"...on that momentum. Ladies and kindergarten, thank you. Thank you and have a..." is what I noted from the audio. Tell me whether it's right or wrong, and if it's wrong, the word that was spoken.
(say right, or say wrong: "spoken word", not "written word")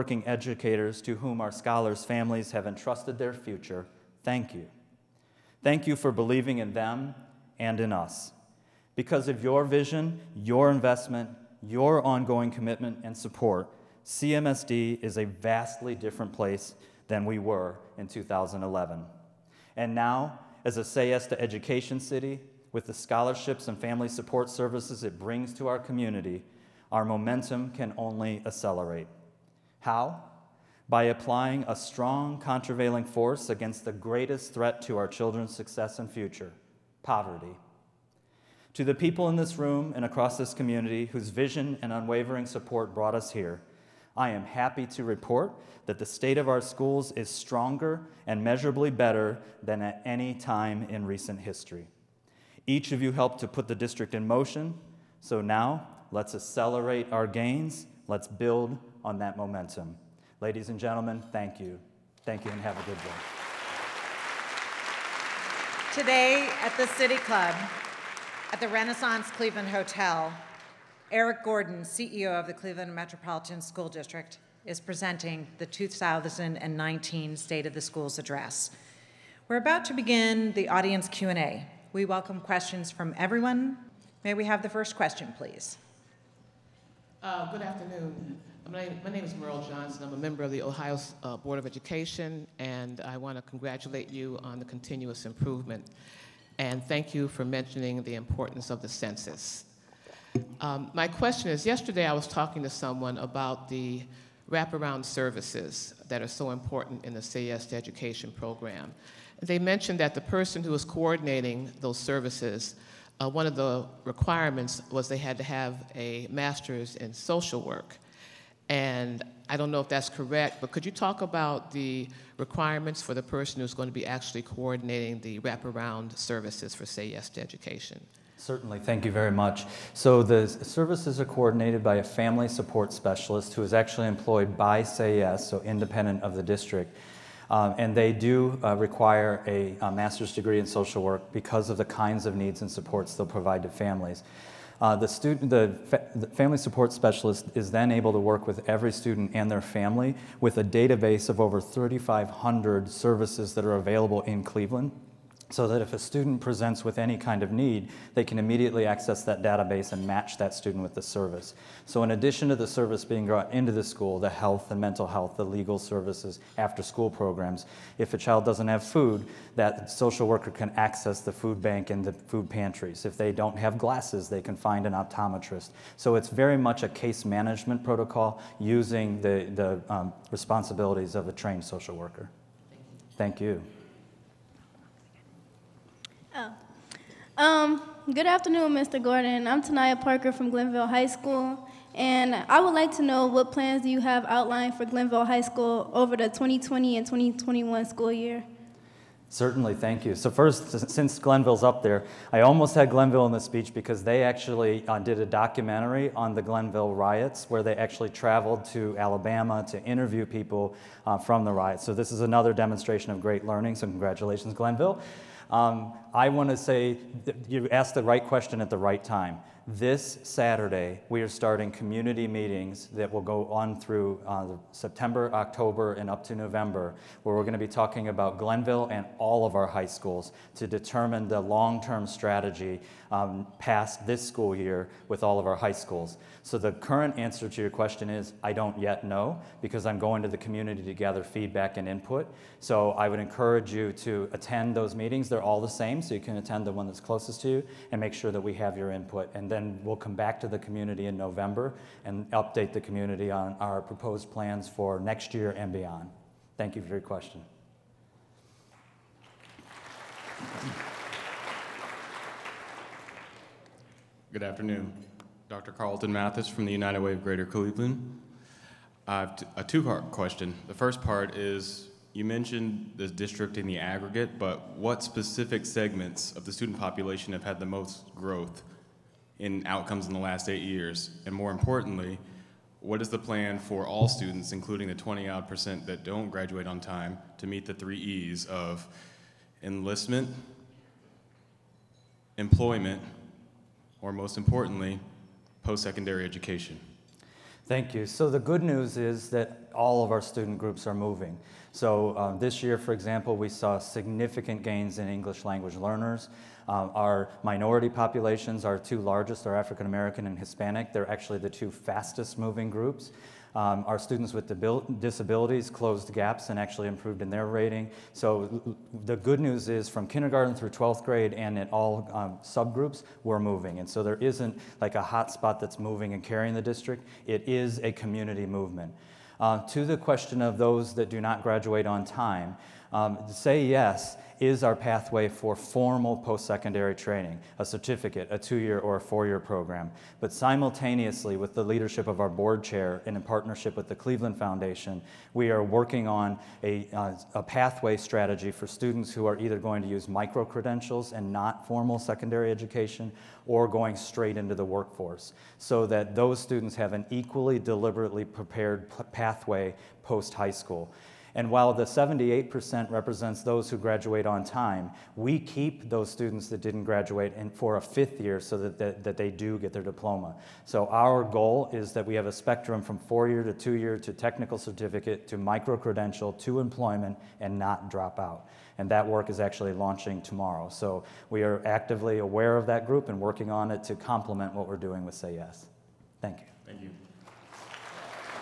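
wrong: "gentlemen", not "kindergarten".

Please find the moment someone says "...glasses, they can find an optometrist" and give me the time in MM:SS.
02:53.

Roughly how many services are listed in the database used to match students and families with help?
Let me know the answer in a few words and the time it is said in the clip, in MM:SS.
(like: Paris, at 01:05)
3,500, at 02:31.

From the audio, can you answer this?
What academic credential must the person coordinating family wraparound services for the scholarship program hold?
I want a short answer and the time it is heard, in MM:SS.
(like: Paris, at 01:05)
Master's in social work, at 02:19.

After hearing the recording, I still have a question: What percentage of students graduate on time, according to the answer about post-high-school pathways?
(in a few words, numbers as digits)
78%.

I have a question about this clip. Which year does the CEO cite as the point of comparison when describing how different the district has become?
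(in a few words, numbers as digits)
2011.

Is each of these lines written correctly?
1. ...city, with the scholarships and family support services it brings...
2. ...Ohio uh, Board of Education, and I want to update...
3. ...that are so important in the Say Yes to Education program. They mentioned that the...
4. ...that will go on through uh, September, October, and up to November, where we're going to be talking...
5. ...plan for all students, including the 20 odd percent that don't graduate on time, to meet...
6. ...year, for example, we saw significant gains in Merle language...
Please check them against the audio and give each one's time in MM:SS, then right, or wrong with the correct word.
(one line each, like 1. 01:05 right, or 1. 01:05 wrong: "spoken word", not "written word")
1. 00:21 right
2. 01:30 wrong: "congratulate", not "update"
3. 01:46 right
4. 03:42 right
5. 04:43 right
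6. 05:02 wrong: "English", not "Merle".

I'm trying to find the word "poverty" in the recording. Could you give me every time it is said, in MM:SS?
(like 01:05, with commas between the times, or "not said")
00:37.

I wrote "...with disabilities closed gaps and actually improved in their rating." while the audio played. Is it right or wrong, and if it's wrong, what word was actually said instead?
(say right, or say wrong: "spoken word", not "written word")
right.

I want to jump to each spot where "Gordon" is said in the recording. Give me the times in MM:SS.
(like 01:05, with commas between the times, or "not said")
01:11, 03:09.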